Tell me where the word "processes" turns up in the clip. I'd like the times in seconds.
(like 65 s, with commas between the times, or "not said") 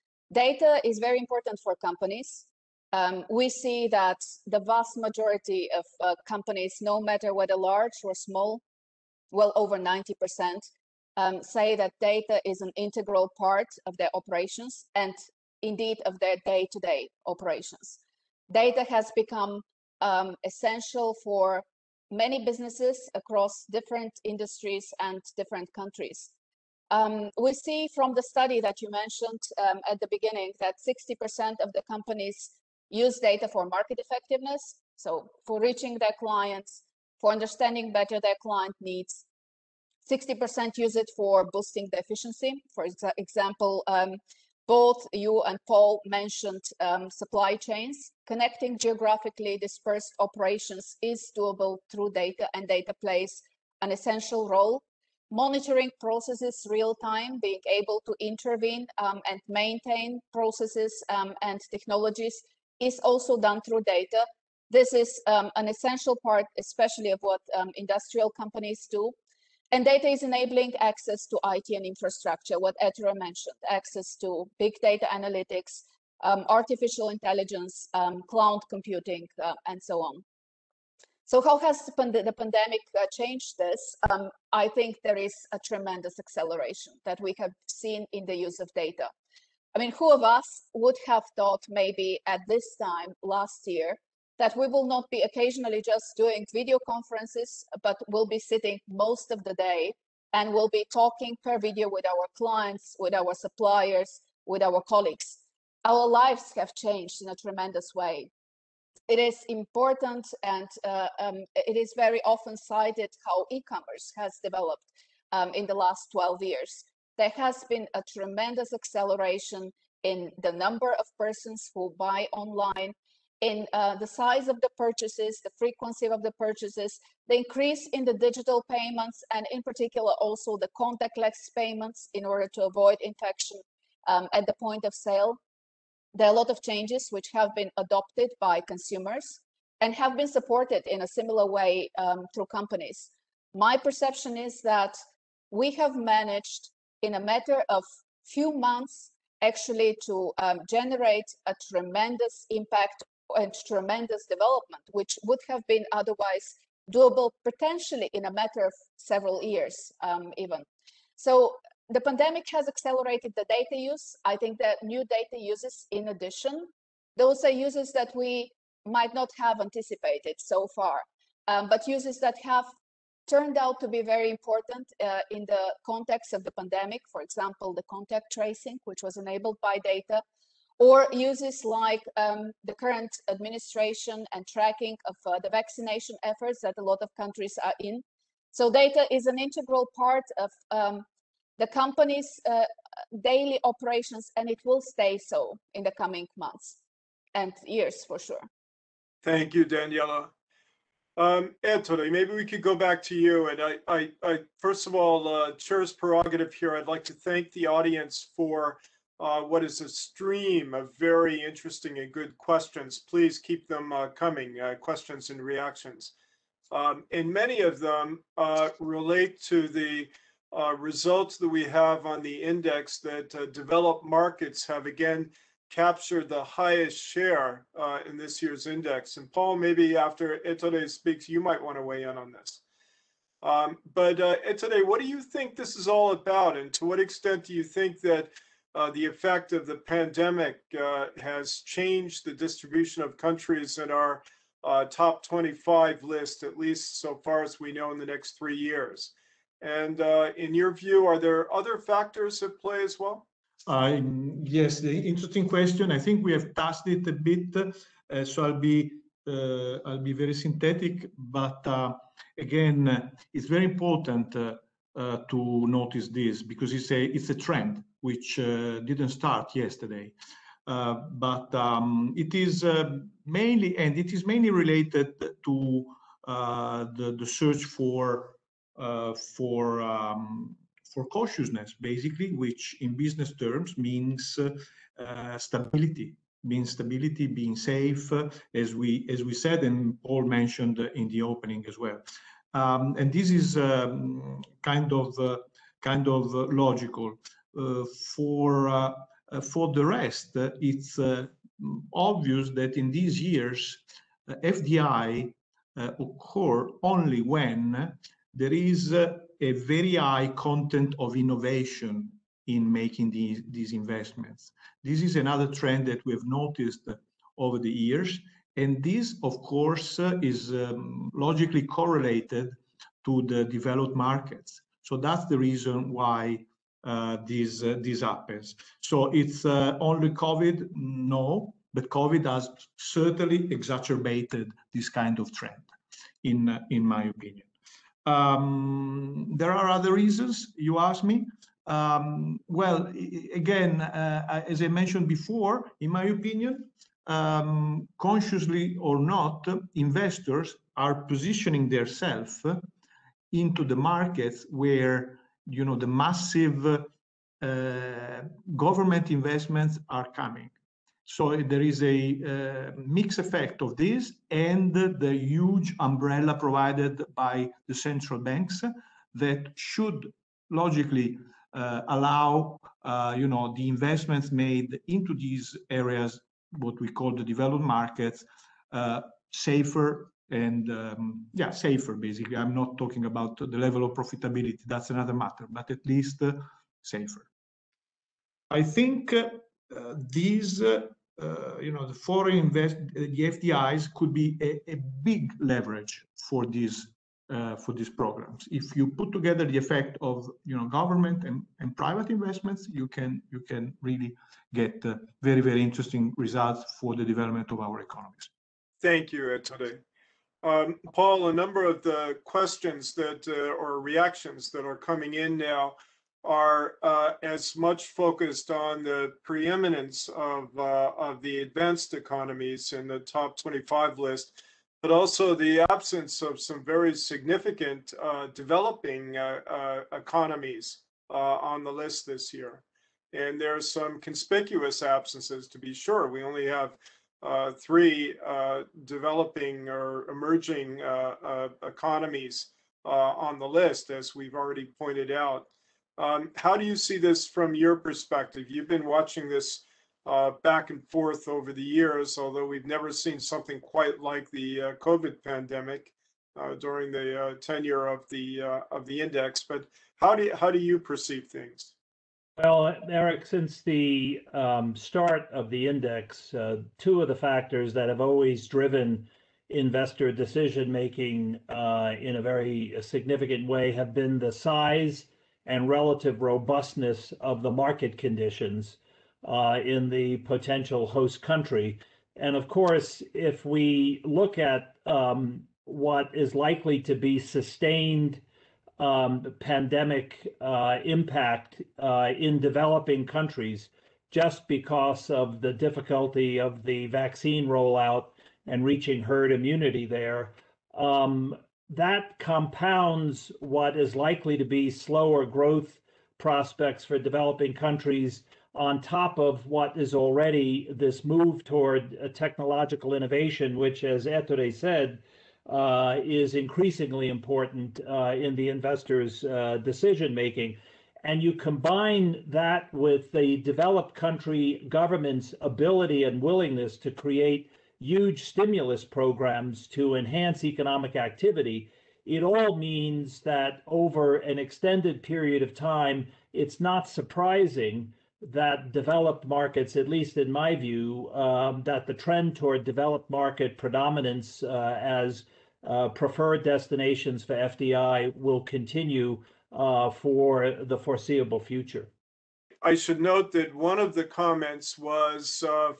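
55 s, 60 s.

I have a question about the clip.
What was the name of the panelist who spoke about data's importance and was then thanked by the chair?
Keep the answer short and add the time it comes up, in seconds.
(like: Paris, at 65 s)
Daniela, at 199 s.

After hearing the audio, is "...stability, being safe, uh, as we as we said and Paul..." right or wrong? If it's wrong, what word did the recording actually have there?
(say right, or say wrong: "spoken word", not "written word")
right.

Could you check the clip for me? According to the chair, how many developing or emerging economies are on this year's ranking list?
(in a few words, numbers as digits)
3.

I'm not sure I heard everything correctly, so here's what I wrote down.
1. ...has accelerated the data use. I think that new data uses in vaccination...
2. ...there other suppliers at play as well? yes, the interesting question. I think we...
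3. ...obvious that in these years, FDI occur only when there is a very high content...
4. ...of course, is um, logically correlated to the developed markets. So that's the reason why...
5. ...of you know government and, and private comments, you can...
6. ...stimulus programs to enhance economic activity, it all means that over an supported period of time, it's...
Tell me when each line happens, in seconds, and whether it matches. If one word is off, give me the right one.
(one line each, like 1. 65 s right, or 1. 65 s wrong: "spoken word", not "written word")
1. 162 s wrong: "addition", not "vaccination"
2. 251 s wrong: "factors", not "suppliers"
3. 301 s right
4. 319 s right
5. 400 s wrong: "investments", not "comments"
6. 528 s wrong: "extended", not "supported".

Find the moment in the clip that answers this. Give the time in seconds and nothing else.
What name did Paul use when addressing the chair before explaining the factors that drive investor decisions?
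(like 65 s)
462 s.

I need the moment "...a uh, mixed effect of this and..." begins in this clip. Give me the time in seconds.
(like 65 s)
361 s.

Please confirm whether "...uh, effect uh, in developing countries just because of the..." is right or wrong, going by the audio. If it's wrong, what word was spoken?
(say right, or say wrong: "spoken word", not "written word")
wrong: "impact", not "effect".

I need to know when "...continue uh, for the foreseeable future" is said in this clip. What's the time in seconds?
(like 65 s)
548 s.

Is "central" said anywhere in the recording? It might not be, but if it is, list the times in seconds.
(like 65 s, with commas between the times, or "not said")
367 s.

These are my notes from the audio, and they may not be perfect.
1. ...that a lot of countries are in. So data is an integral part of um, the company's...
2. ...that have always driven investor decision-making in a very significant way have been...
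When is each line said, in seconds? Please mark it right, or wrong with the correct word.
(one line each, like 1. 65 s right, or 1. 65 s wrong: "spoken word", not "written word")
1. 186 s right
2. 467 s right.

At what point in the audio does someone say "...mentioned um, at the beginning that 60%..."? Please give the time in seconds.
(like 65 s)
28 s.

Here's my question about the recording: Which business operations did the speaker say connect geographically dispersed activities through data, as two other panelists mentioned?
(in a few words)
supply chains.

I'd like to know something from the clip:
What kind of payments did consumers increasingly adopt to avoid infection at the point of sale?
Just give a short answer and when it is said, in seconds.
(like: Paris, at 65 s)
contactless payments, at 130 s.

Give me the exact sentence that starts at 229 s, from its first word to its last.
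And Paul, maybe after Ettore speaks, you might want to weigh in on this.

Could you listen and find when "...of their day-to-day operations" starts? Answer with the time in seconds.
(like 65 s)
16 s.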